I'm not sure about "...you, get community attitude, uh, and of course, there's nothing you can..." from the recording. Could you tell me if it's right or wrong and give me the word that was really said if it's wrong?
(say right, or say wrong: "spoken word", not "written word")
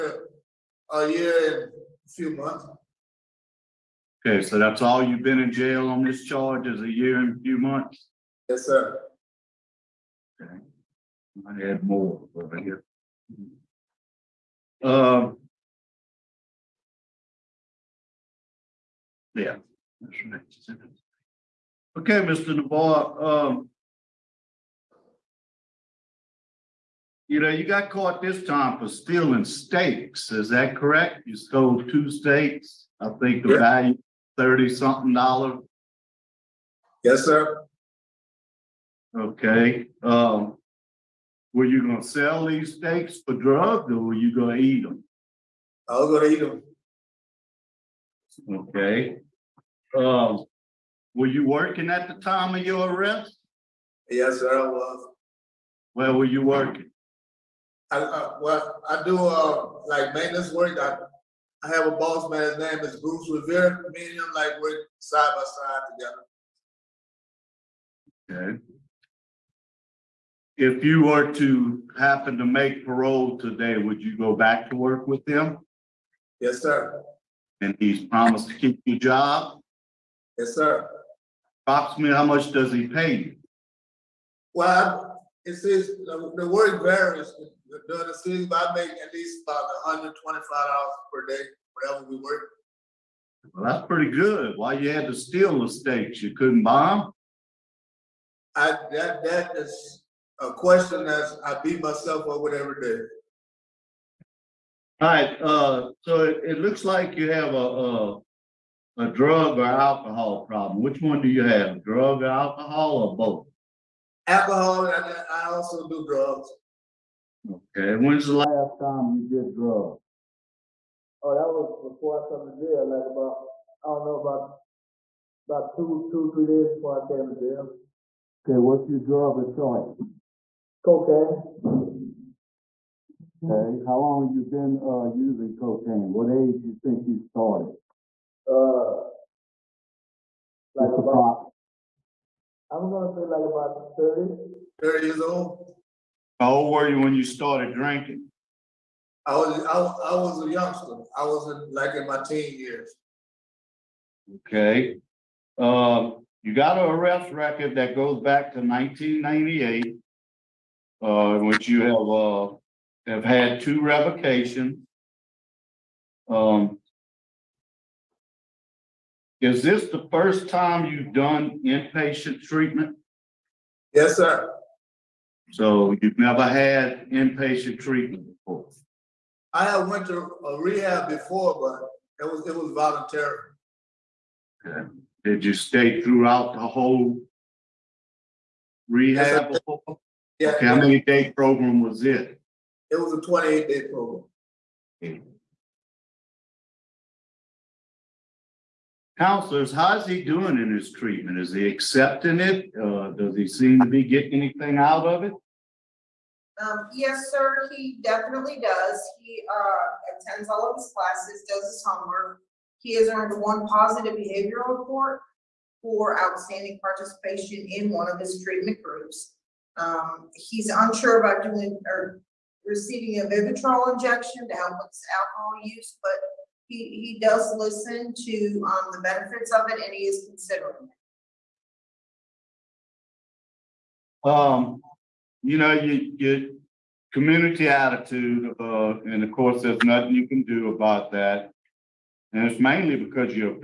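right.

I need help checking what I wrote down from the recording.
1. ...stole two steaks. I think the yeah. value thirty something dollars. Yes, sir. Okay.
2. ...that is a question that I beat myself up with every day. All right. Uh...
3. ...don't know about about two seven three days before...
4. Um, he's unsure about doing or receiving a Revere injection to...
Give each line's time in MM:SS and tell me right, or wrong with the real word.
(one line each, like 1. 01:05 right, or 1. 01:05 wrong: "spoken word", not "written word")
1. 00:31 right
2. 01:39 right
3. 02:03 wrong: "two", not "seven"
4. 03:39 wrong: "Vivitrol", not "Revere".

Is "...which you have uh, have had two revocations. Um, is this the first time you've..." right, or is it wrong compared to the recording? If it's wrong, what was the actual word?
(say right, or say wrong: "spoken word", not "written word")
right.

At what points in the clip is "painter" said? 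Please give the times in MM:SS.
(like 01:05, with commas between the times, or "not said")
not said.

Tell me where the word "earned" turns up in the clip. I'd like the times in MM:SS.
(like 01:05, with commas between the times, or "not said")
03:33.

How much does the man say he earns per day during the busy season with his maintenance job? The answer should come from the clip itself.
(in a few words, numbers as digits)
$125.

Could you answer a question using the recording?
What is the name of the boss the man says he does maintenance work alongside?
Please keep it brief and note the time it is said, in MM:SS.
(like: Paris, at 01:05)
Bruce Revere, at 01:02.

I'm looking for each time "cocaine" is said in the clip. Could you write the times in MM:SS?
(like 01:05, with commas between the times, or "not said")
02:10, 02:15.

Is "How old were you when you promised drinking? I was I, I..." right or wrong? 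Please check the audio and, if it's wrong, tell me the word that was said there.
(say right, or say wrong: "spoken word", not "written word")
wrong: "started", not "promised".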